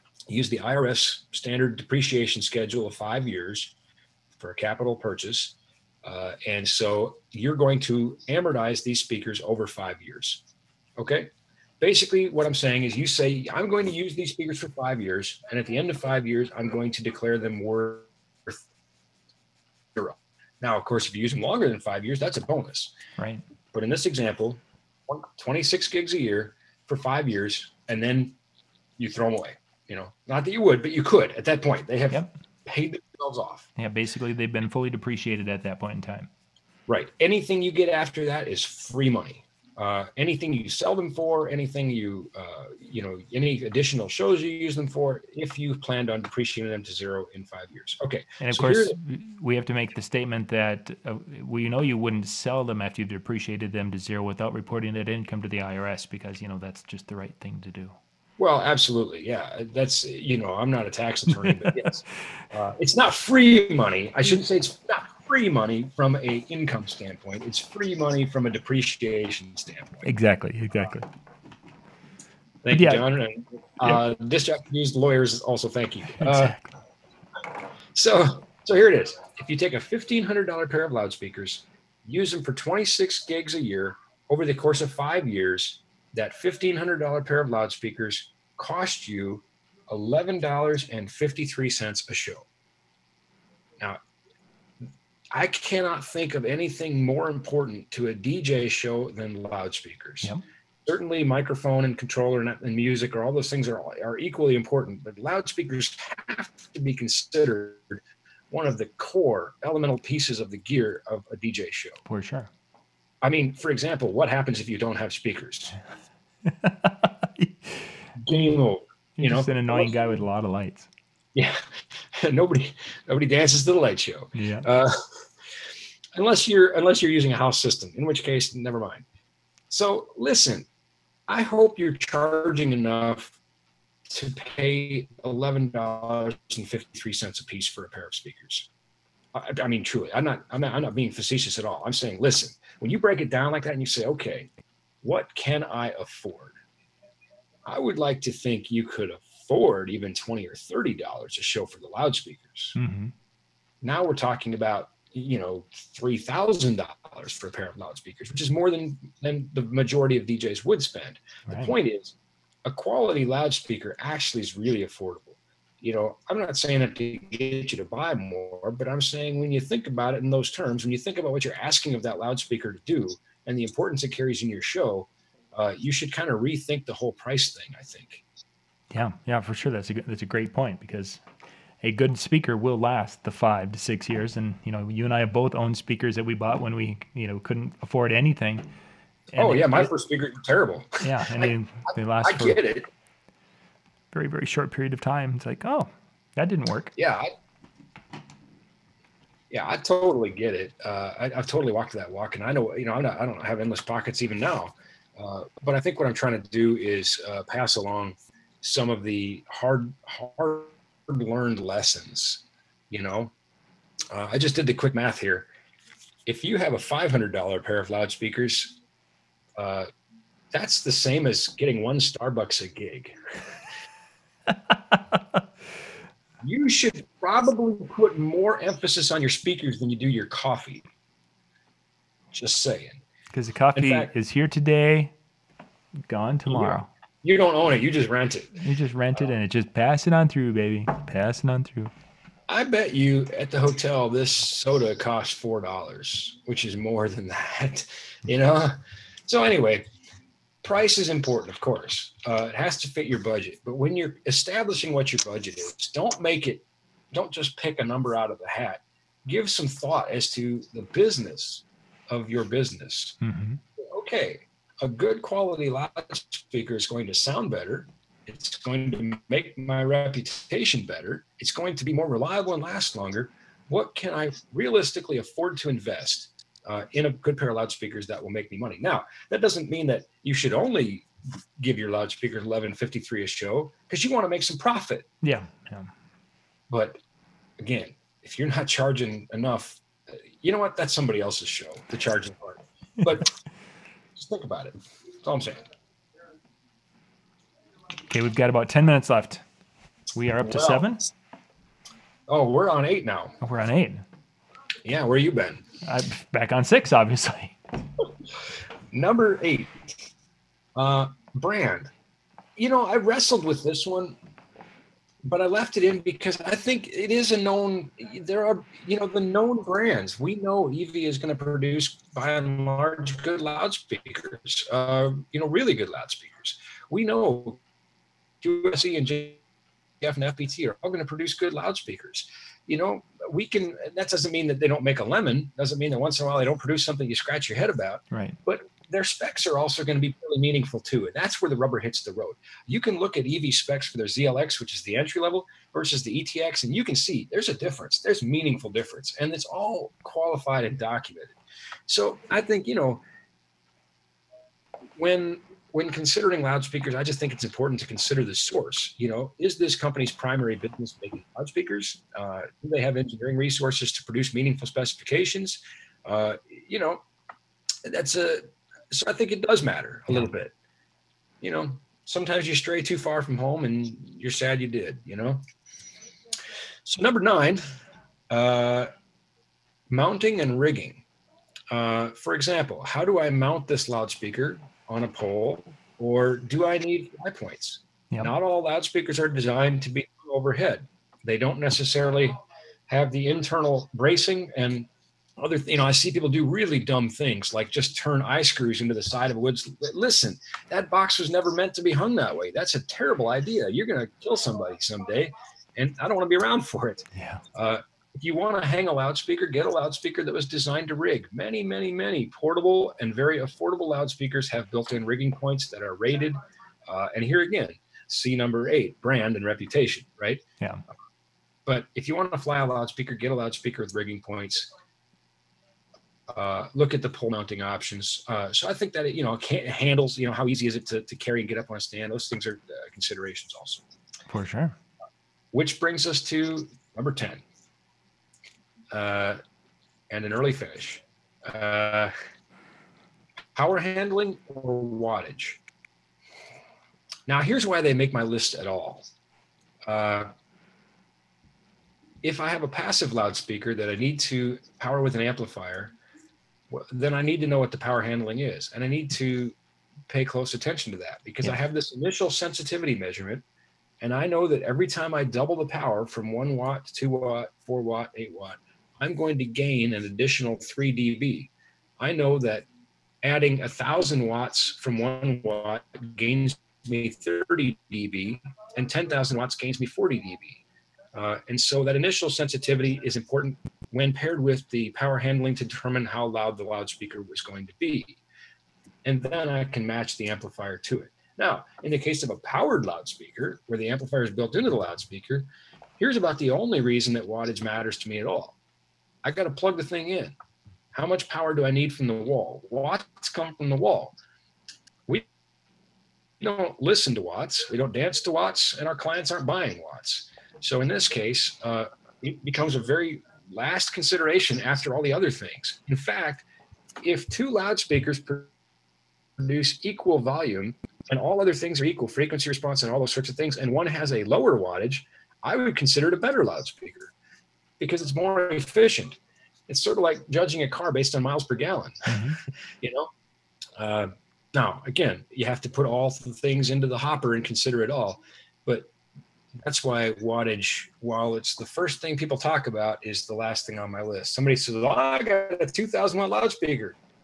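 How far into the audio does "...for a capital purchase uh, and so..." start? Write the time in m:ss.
0:04.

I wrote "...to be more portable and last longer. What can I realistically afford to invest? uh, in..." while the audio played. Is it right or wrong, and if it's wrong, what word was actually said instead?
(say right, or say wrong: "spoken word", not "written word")
wrong: "reliable", not "portable".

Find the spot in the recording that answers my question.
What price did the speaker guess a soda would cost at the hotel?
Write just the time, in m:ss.
4:05.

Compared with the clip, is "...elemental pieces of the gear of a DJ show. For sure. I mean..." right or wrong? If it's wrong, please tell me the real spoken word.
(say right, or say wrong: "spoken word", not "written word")
right.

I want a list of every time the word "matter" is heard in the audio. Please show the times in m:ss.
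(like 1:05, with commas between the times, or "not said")
6:09, 8:17.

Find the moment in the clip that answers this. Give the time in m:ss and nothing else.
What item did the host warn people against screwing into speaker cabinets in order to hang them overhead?
6:38.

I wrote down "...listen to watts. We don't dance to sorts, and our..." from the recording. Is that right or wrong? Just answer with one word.
wrong.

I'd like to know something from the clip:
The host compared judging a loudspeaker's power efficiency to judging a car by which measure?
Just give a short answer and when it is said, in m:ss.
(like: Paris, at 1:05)
Miles per gallon, at 8:51.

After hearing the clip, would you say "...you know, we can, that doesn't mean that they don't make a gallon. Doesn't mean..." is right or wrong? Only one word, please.
wrong.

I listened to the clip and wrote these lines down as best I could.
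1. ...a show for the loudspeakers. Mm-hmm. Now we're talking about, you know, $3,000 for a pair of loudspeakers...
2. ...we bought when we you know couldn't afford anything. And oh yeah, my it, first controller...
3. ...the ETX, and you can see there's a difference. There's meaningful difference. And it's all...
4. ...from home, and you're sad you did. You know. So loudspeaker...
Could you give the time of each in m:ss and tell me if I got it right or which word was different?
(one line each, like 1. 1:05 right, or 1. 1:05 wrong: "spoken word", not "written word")
1. 2:31 right
2. 3:06 wrong: "speaker", not "controller"
3. 5:46 right
4. 6:13 wrong: "number", not "loudspeaker".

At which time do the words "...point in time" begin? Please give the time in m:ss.
0:35.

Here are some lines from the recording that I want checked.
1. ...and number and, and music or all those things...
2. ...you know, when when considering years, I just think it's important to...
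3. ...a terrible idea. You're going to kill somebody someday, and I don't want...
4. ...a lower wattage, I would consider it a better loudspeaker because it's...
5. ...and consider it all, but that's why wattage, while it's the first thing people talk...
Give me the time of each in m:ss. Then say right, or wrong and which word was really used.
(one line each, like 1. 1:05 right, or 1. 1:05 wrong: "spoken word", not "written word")
1. 1:41 wrong: "controller", not "number"
2. 5:52 wrong: "loudspeakers", not "years"
3. 6:42 right
4. 8:44 right
5. 8:57 right.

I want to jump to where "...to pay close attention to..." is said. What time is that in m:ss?
7:39.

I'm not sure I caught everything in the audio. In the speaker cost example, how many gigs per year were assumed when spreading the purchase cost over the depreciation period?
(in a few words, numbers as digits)
26.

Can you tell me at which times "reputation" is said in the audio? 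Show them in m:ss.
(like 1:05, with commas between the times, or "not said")
4:29, 6:59.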